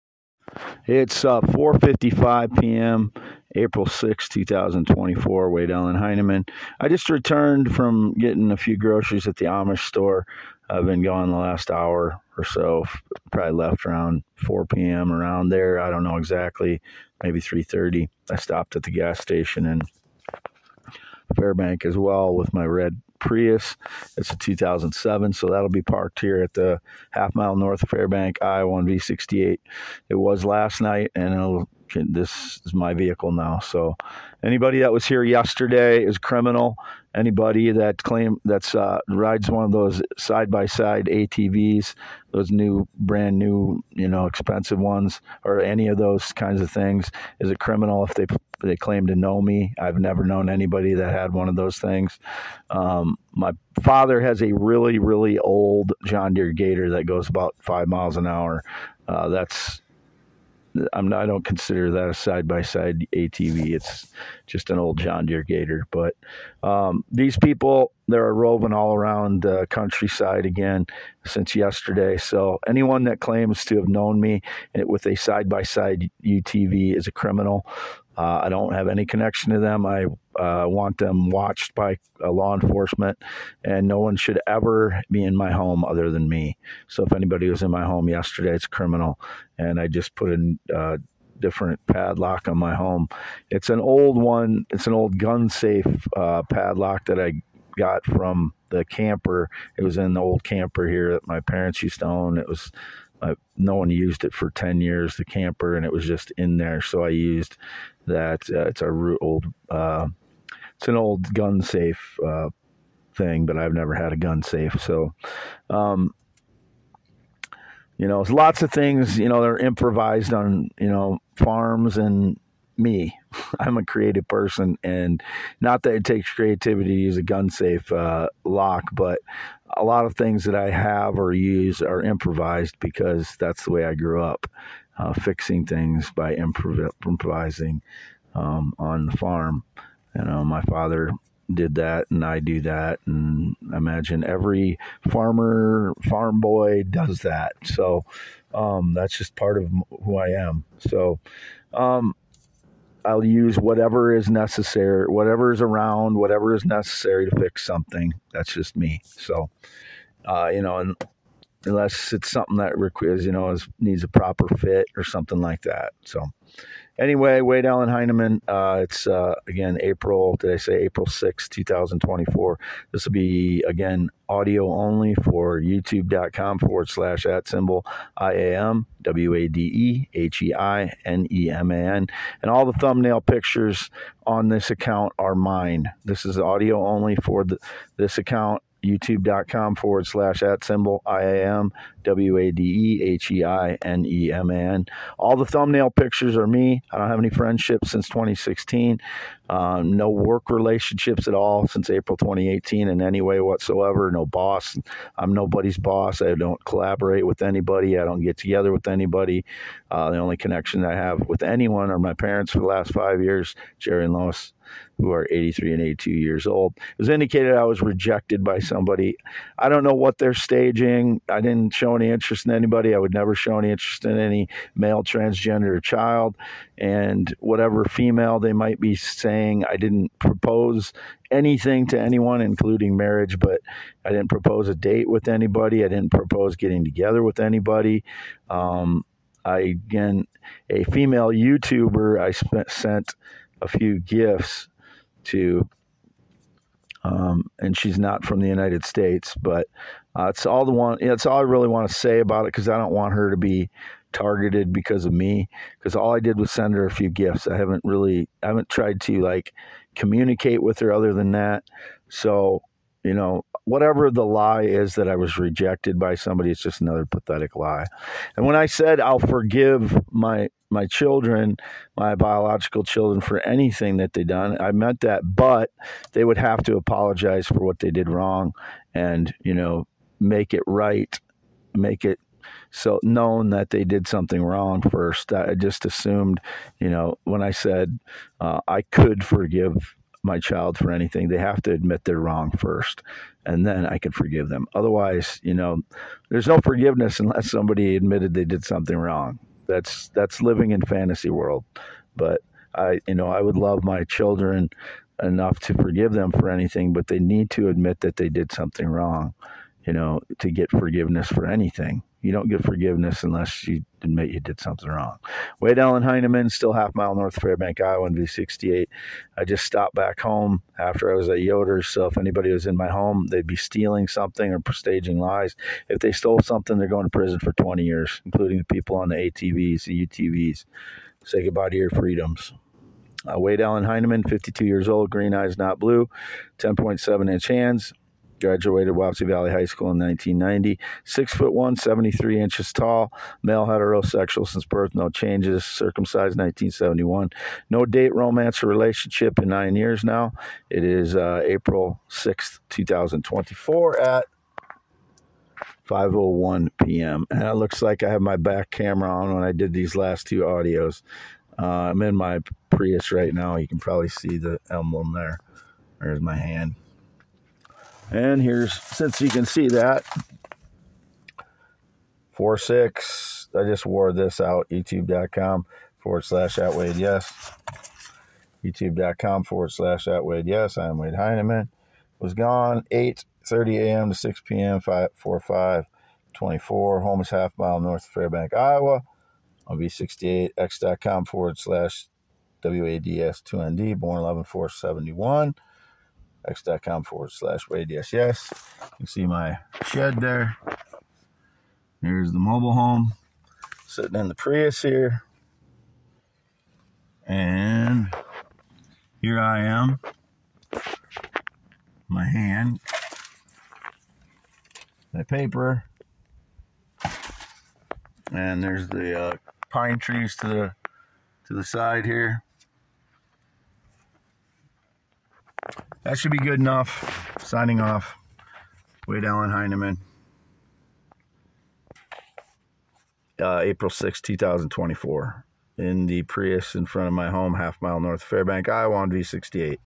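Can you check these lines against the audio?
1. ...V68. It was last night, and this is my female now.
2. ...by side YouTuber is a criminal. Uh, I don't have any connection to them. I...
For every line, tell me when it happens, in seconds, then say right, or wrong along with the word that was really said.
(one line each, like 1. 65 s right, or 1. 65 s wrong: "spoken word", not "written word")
1. 28 s wrong: "vehicle", not "female"
2. 75 s wrong: "UTV", not "YouTuber".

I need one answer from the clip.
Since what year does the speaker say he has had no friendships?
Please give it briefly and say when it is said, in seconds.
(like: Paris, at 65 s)
2016, at 198 s.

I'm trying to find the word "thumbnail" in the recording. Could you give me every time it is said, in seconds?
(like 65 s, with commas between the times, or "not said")
182 s, 195 s.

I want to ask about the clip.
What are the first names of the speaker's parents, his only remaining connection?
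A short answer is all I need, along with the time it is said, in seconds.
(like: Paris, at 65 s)
Jerry and Lois, at 213 s.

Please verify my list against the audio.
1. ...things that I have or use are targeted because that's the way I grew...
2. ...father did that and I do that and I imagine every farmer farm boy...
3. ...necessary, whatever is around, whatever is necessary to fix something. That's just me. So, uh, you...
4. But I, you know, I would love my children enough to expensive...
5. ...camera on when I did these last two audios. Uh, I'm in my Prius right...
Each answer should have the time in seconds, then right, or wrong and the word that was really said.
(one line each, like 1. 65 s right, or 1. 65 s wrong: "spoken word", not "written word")
1. 130 s wrong: "improvised", not "targeted"
2. 140 s right
3. 154 s right
4. 302 s wrong: "forgive", not "expensive"
5. 358 s right.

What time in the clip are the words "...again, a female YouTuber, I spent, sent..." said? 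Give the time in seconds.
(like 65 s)
239 s.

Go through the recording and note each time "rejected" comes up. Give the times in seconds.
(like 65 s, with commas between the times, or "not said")
217 s, 265 s.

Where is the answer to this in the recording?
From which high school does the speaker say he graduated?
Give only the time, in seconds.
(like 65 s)
338 s.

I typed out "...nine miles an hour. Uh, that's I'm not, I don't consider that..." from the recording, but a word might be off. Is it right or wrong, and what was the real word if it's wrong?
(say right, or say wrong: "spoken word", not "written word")
wrong: "five", not "nine".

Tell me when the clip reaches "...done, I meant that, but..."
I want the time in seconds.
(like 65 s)
274 s.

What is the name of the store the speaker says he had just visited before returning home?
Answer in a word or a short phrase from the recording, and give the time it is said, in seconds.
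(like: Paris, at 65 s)
Yoder's, at 321 s.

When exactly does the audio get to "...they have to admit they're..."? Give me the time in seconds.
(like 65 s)
291 s.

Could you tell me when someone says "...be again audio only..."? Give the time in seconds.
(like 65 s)
173 s.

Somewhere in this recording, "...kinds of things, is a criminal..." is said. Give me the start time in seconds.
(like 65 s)
46 s.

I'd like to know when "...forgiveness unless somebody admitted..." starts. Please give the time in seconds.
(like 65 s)
296 s.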